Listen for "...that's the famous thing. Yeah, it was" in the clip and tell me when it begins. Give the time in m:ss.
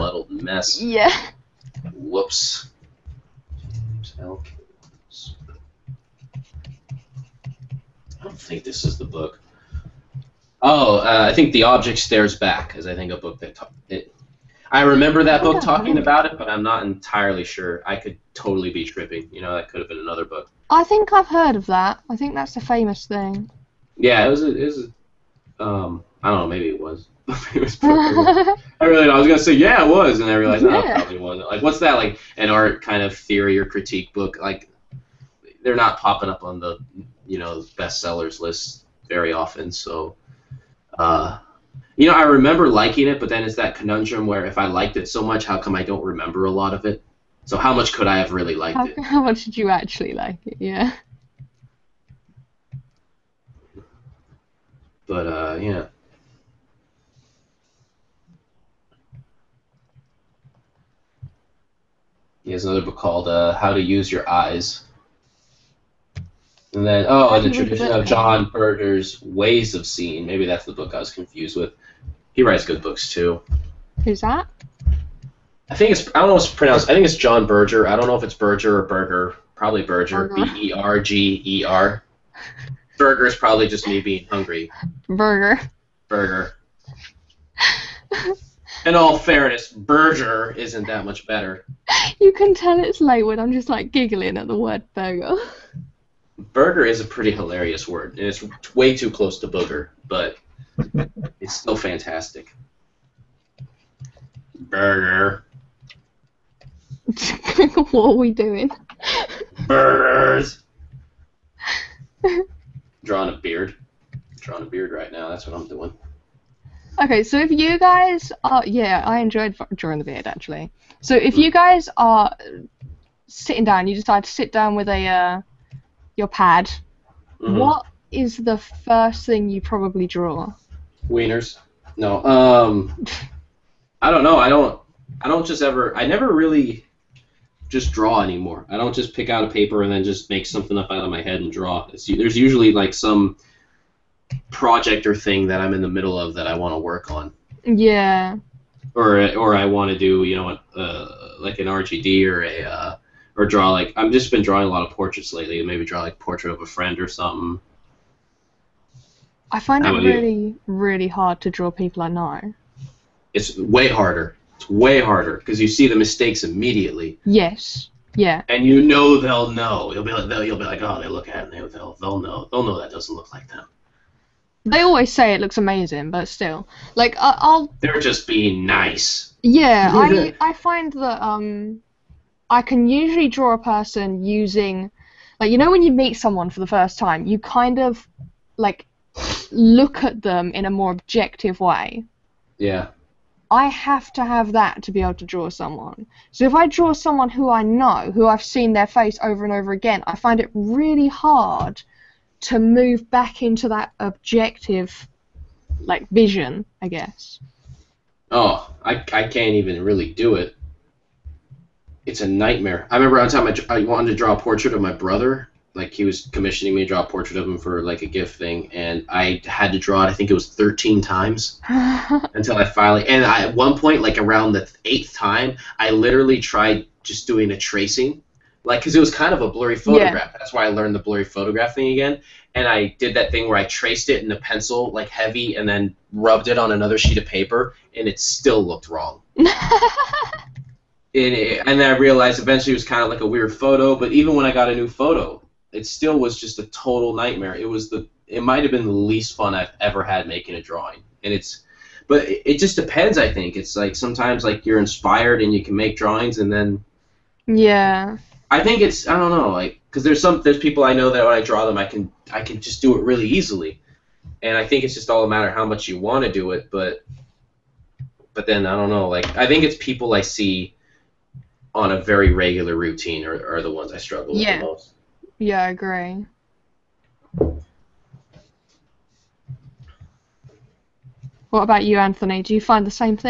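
0:22.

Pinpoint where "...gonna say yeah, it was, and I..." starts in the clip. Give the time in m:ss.
0:29.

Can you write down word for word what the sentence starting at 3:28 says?
Oh, I, I can't even really do it it's a nightmare.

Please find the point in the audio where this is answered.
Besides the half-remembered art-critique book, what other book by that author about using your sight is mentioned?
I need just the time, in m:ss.
1:03.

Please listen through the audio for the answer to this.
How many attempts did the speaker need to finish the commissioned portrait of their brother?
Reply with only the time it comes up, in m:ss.
3:40.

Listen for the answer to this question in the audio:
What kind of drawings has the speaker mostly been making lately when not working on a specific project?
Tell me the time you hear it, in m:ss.
2:34.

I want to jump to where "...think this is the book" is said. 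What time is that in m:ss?
0:08.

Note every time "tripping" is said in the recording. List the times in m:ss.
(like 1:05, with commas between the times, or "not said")
0:18.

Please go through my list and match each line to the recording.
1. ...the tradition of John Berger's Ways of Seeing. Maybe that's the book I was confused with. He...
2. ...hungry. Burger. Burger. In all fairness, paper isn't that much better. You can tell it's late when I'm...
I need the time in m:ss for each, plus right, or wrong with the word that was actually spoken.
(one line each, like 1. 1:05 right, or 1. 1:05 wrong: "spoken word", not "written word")
1. 1:07 right
2. 1:24 wrong: "burger", not "paper".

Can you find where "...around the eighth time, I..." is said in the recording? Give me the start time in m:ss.
3:44.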